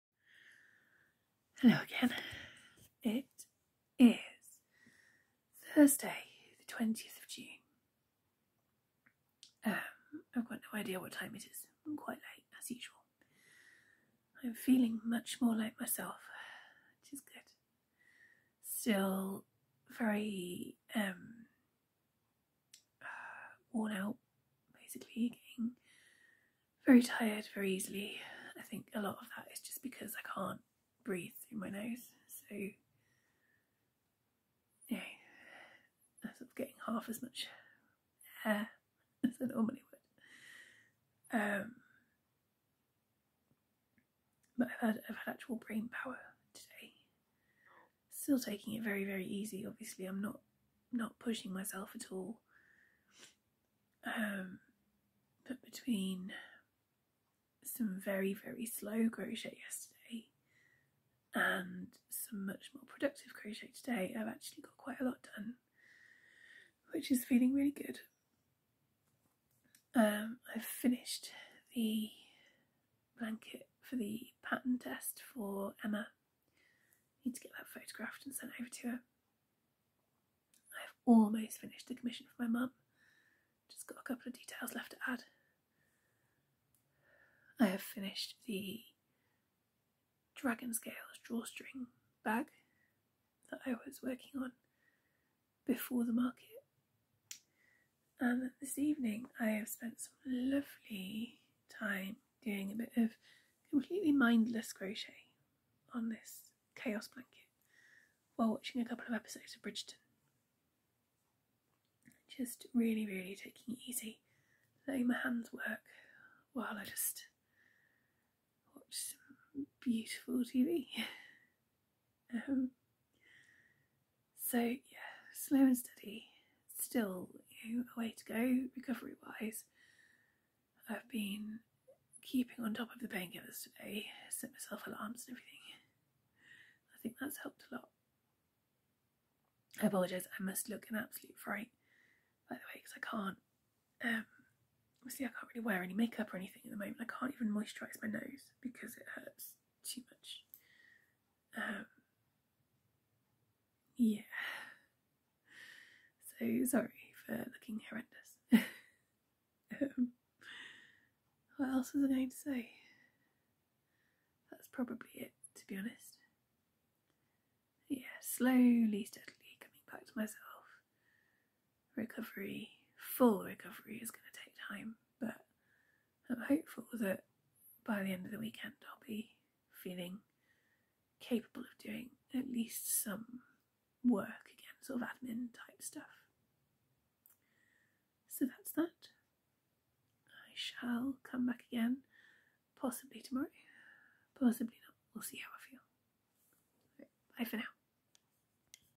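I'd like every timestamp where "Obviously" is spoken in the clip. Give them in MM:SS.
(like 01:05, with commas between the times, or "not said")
00:49.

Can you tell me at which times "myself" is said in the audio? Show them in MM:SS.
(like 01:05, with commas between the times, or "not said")
00:15, 00:51, 02:14, 02:50.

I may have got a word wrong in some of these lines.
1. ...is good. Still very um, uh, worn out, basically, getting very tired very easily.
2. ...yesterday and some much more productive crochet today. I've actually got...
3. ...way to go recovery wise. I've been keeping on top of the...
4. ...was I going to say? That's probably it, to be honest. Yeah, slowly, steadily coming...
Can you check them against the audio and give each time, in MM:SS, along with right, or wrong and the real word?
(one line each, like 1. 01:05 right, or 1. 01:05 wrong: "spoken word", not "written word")
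1. 00:17 right
2. 00:59 right
3. 02:07 right
4. 02:41 right.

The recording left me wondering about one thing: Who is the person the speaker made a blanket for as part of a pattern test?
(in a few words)
Emma.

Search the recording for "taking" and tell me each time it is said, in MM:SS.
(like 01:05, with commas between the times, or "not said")
00:48, 01:53.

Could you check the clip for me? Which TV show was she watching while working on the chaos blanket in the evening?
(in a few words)
Bridgerton.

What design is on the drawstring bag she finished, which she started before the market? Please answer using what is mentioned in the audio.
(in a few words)
Dragon scales.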